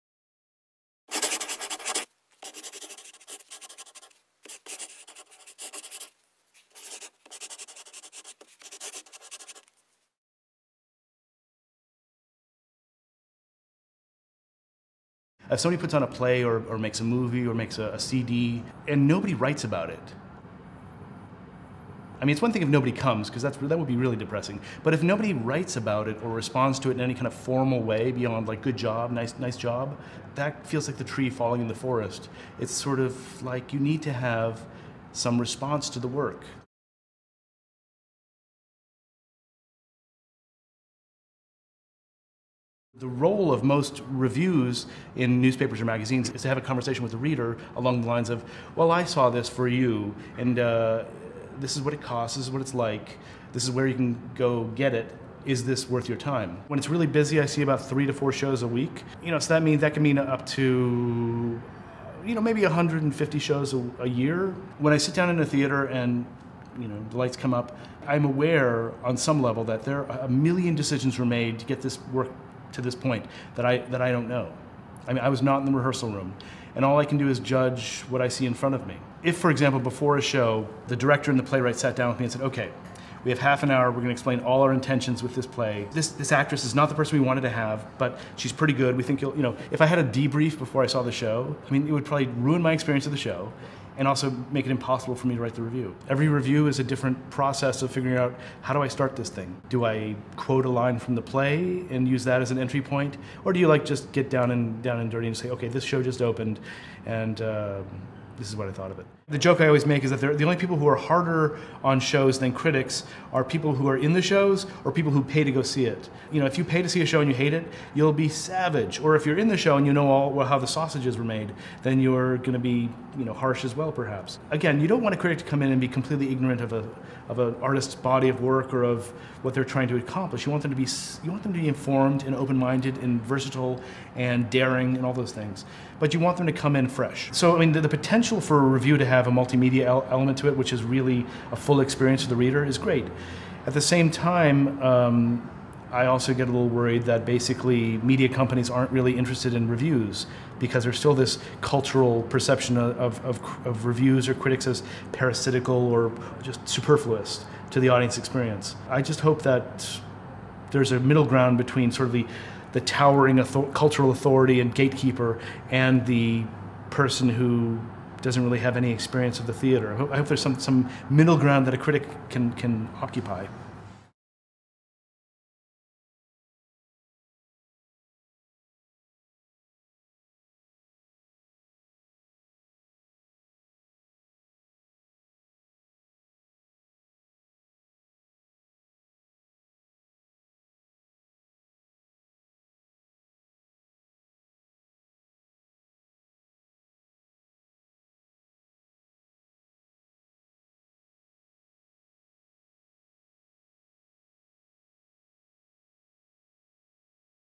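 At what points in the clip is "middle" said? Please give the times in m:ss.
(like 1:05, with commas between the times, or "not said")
2:40, 2:51.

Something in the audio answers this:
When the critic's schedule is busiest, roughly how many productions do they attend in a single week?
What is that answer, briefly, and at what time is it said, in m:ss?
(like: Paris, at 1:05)
3 to 4, at 0:57.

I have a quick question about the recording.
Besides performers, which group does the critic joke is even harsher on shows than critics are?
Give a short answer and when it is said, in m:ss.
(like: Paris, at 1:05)
people who pay, at 1:54.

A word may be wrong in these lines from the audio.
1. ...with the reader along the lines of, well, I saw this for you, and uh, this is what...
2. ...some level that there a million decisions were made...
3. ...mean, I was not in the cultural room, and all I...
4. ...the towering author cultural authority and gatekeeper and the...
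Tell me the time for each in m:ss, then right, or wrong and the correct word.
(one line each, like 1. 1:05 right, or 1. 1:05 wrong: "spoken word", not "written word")
1. 0:47 right
2. 1:09 right
3. 1:15 wrong: "rehearsal", not "cultural"
4. 2:42 right.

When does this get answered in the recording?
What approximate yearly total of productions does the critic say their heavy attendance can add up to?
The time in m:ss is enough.
1:02.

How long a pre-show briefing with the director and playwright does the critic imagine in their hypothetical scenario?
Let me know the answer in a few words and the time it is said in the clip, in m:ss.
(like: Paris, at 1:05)
half an hour, at 1:23.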